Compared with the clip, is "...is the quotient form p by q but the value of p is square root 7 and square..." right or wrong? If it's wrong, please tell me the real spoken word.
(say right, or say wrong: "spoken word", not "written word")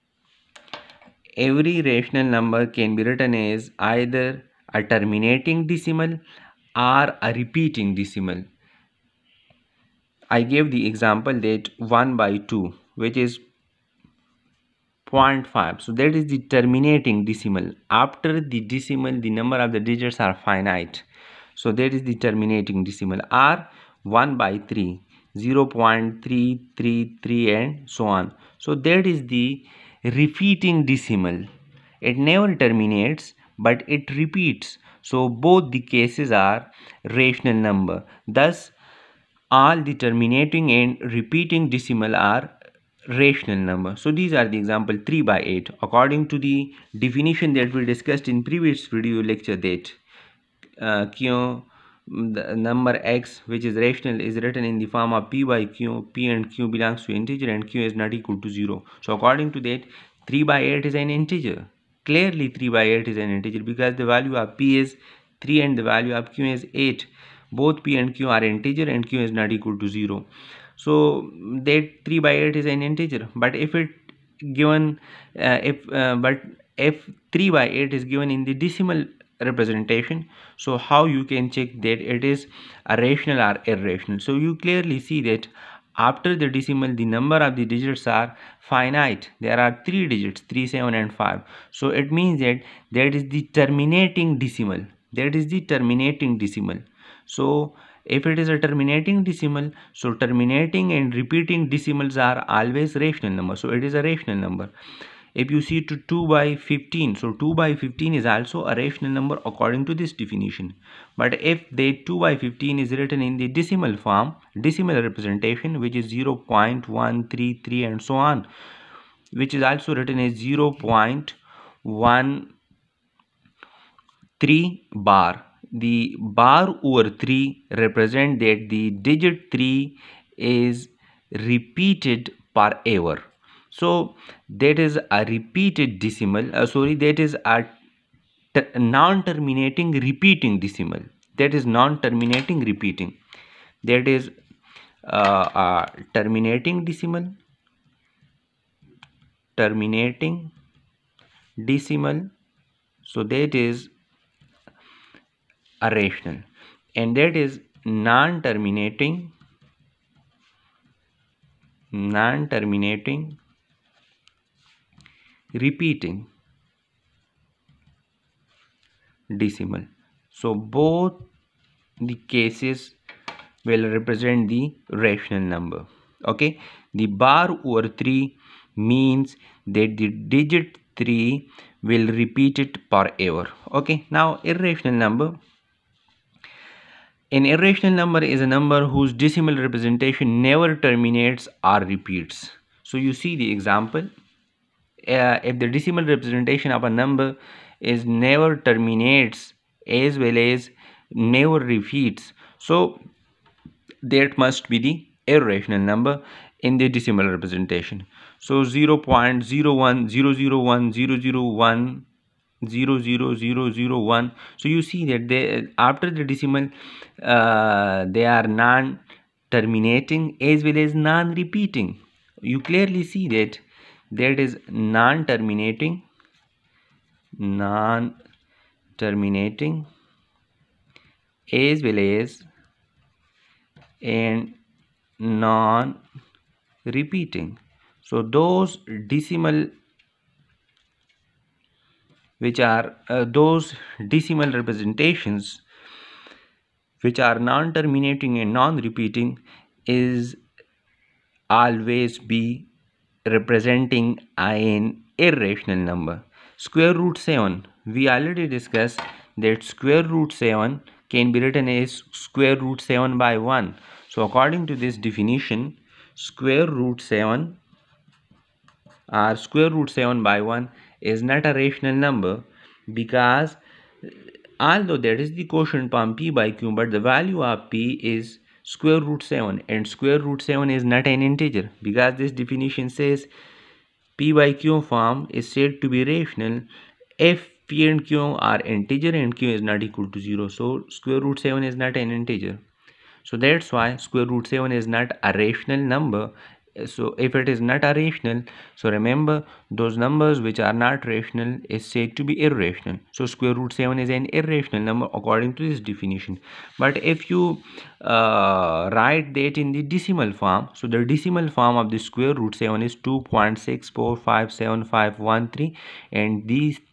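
right.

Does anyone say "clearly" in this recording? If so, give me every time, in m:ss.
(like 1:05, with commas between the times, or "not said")
1:02, 1:24, 3:42.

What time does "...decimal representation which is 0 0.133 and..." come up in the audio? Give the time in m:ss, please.
1:54.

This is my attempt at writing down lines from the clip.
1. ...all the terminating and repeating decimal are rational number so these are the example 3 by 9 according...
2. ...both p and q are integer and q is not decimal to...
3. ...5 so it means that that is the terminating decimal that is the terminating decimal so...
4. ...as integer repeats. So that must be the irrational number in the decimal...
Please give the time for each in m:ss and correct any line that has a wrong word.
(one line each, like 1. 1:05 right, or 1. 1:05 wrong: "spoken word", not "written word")
1. 0:39 wrong: "8", not "9"
2. 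1:07 wrong: "equal", not "decimal"
3. 1:31 right
4. 3:20 wrong: "never", not "integer".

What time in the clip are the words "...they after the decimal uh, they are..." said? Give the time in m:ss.
3:35.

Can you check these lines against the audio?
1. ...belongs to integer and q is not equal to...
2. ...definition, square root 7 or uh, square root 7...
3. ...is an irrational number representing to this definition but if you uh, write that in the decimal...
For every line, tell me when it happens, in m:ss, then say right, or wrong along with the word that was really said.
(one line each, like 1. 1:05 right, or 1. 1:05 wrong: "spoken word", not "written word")
1. 0:56 right
2. 4:24 right
3. 5:03 wrong: "according", not "representing".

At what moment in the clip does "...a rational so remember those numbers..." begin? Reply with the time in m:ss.
4:57.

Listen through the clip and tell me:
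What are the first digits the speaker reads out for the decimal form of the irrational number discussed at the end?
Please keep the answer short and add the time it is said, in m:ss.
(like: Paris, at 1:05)
2.6457513, at 5:12.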